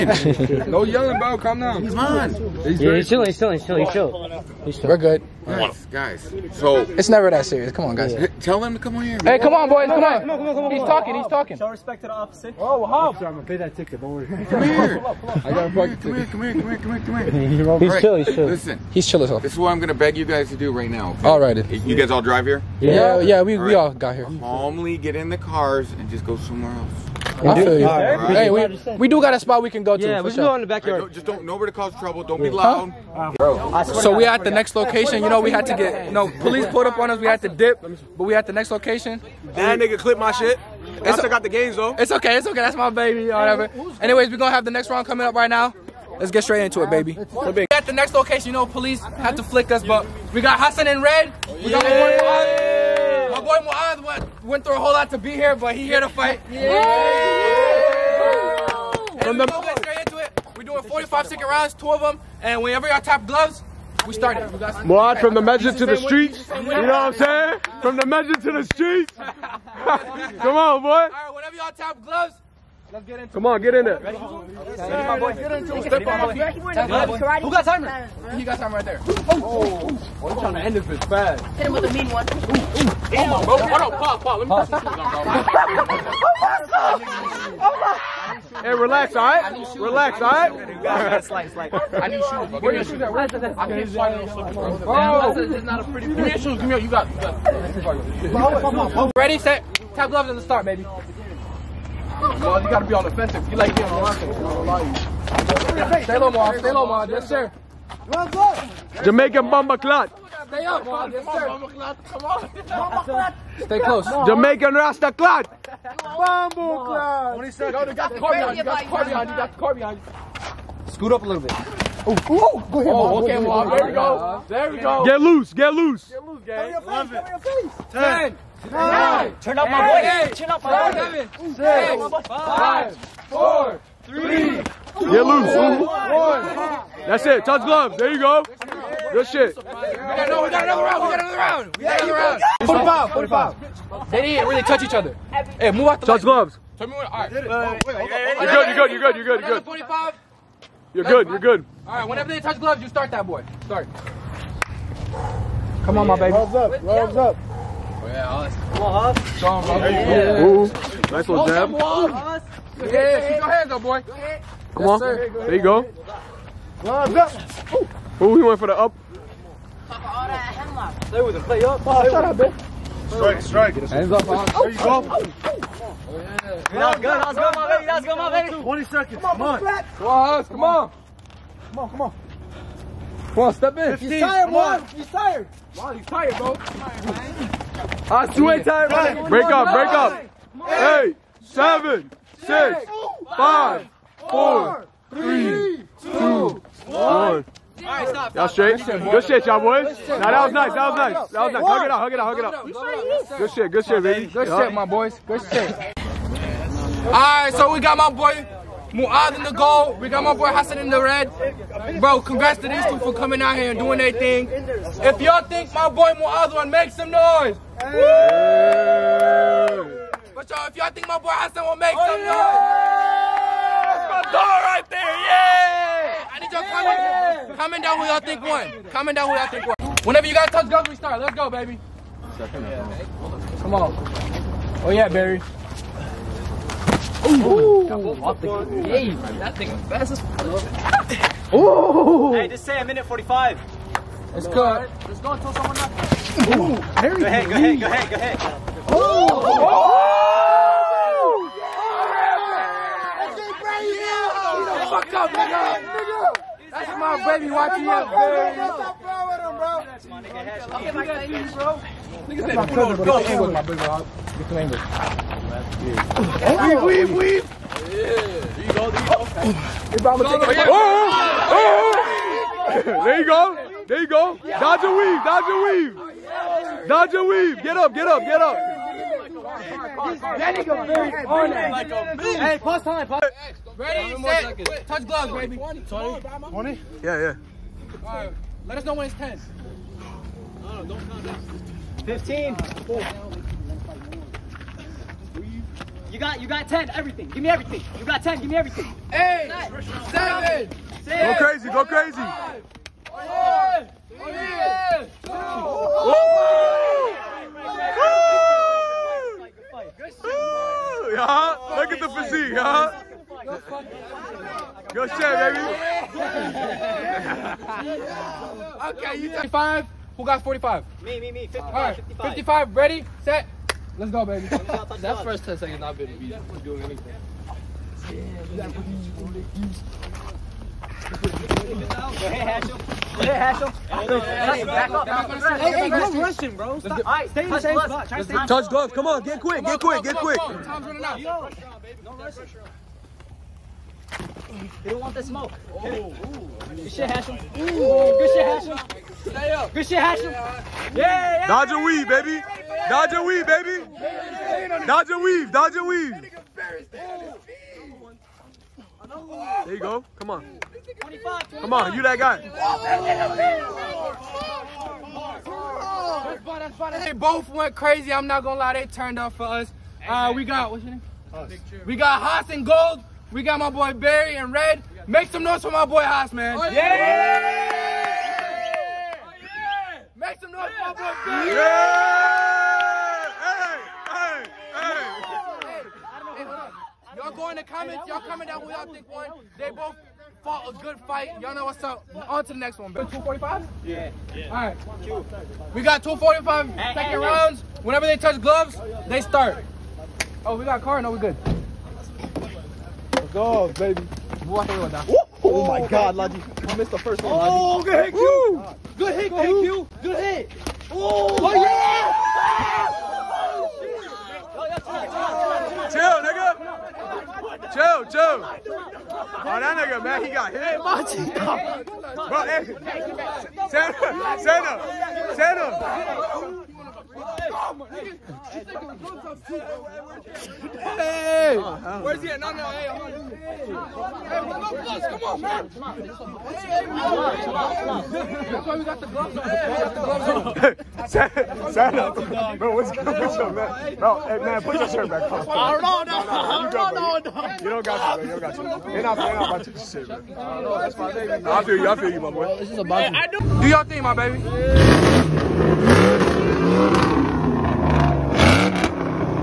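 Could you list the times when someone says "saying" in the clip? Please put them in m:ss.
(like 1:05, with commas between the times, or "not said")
1:07.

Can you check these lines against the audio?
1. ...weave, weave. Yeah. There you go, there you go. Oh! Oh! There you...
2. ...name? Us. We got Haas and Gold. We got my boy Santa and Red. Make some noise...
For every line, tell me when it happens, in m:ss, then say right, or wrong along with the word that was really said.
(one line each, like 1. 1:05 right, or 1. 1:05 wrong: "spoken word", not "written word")
1. 4:27 right
2. 6:10 wrong: "Barry", not "Santa".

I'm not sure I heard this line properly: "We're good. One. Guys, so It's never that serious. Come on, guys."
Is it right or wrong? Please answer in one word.
right.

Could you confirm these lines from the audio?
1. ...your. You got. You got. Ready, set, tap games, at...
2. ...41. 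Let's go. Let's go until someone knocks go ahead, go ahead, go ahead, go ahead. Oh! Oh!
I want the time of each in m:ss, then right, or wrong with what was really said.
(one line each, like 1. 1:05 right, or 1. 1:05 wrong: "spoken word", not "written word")
1. 1:36 wrong: "gloves", not "games"
2. 4:03 wrong: "45", not "41".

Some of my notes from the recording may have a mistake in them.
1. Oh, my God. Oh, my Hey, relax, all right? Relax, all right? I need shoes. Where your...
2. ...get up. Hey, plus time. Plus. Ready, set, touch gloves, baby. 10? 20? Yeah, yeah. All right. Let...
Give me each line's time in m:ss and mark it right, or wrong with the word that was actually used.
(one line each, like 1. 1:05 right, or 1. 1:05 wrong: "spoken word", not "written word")
1. 1:26 right
2. 4:38 wrong: "20", not "10".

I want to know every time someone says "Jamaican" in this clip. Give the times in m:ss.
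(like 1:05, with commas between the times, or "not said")
1:49, 1:54.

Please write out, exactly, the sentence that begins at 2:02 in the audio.
Ooh, ooh, go ahead, oh, okay, There we go.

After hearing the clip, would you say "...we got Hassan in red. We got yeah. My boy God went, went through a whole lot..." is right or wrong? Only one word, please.
wrong.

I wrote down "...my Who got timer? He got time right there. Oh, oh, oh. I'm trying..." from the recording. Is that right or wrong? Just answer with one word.
right.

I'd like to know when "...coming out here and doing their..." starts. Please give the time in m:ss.
3:33.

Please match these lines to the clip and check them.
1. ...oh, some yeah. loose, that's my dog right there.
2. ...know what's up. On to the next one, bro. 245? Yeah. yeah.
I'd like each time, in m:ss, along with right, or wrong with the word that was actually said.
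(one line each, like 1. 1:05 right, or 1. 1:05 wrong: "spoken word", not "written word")
1. 3:41 wrong: "noise", not "loose"
2. 6:31 right.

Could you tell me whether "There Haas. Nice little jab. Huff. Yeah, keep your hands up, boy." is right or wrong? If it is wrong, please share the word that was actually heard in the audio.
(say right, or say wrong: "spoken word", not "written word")
wrong: "Ooh", not "Haas".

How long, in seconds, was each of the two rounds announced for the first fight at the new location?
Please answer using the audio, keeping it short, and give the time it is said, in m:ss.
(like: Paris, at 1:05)
45, at 1:00.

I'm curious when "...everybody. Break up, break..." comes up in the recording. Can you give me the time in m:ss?
3:08.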